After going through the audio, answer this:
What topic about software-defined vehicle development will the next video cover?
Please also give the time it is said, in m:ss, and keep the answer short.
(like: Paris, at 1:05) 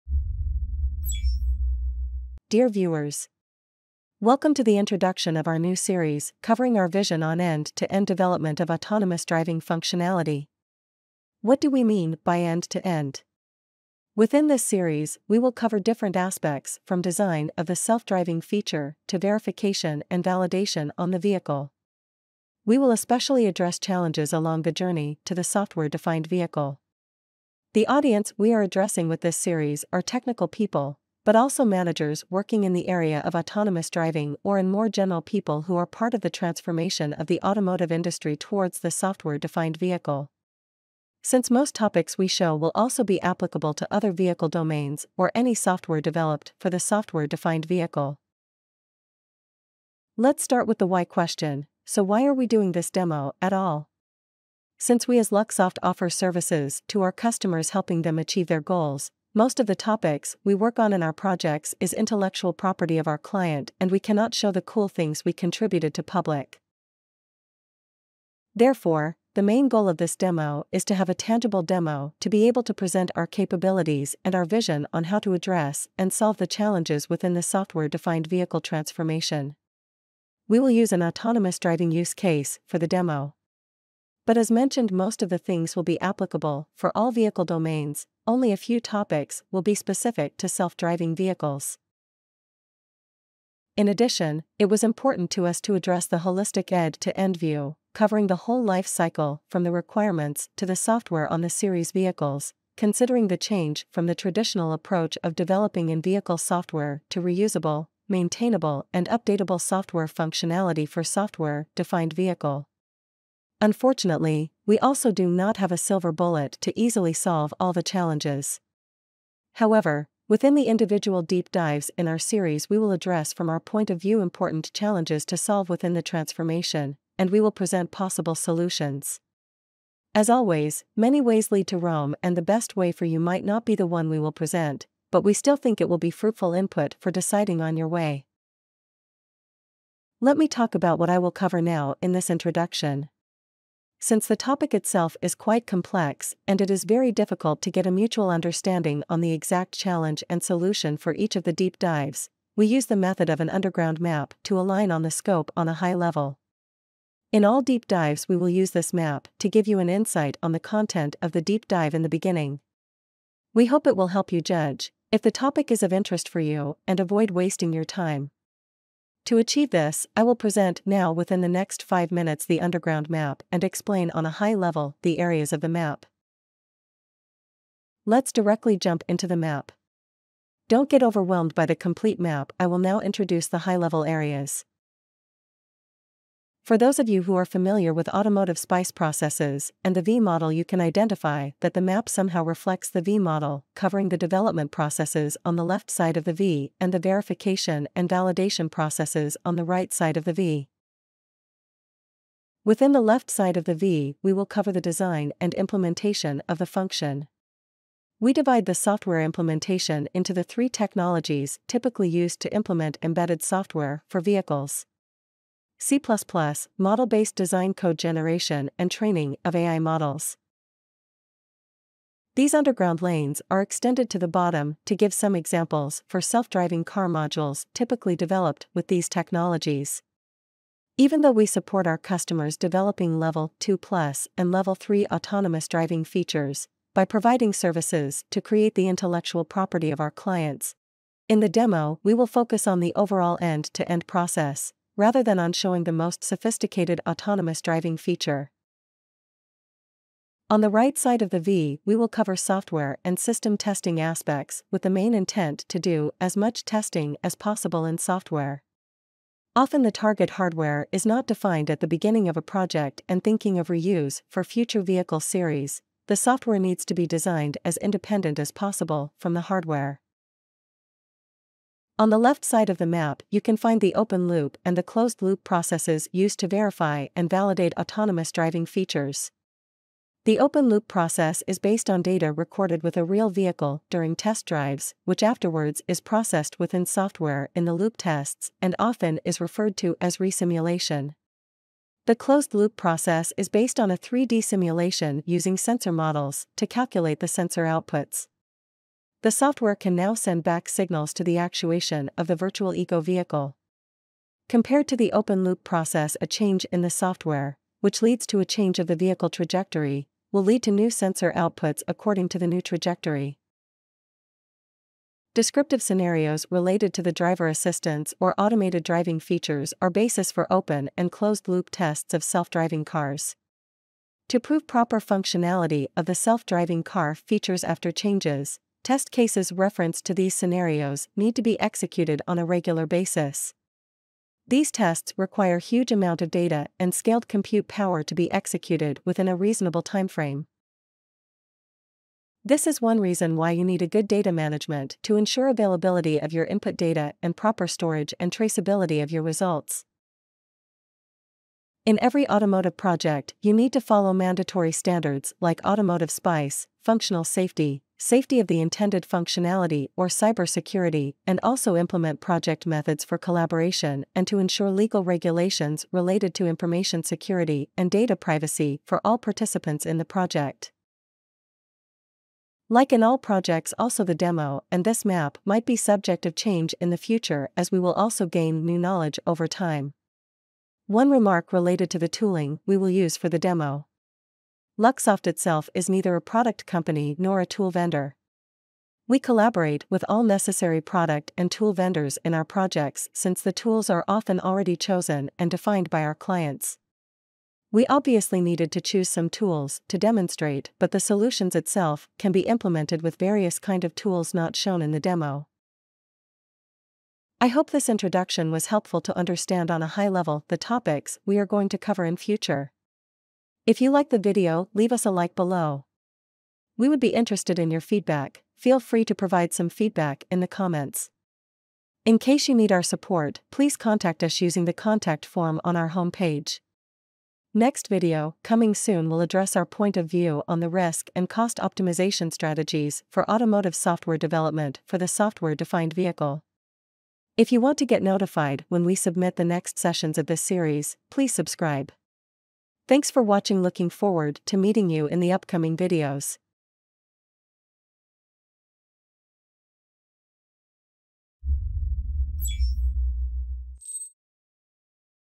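Risk and cost optimization strategies, at 7:10.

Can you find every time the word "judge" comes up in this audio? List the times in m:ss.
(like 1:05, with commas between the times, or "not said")
2:44.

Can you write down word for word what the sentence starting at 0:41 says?
Since most topics we show will also be applicable to other vehicle domains or any software developed for the software-defined vehicle.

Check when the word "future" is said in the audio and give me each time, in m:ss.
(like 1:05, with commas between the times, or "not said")
4:24, 6:16, 6:52.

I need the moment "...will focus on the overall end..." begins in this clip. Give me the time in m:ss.
4:02.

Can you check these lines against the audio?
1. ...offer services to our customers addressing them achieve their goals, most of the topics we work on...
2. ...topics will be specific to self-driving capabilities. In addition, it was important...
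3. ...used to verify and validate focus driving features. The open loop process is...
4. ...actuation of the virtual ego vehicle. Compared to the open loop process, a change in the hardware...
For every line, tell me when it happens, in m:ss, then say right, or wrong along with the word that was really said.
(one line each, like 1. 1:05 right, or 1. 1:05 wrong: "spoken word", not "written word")
1. 0:55 wrong: "helping", not "addressing"
2. 1:28 wrong: "vehicles", not "capabilities"
3. 4:36 wrong: "autonomous", not "focus"
4. 5:01 wrong: "software", not "hardware".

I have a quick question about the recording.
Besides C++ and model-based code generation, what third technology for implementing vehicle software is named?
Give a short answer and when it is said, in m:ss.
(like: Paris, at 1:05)
Training of AI models, at 3:38.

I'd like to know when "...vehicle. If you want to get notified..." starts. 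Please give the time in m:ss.
7:15.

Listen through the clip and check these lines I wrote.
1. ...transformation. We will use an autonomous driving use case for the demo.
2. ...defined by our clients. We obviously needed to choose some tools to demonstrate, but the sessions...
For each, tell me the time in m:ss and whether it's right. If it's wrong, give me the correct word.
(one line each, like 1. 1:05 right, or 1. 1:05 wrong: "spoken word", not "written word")
1. 1:18 right
2. 6:35 wrong: "solutions", not "sessions".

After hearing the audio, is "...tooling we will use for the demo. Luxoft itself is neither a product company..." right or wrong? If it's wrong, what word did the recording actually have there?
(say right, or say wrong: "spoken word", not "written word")
right.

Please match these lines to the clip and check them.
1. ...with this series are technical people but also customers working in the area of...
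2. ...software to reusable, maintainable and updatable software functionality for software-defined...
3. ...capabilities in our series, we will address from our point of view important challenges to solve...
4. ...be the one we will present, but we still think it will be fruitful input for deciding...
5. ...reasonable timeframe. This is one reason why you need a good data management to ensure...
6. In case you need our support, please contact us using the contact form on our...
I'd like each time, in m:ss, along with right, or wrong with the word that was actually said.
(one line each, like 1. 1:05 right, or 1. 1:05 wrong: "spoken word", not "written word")
1. 0:29 wrong: "managers", not "customers"
2. 1:46 right
3. 2:01 wrong: "dives", not "capabilities"
4. 2:13 right
5. 5:39 right
6. 7:02 right.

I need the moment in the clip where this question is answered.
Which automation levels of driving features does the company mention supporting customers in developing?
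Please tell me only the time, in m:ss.
3:53.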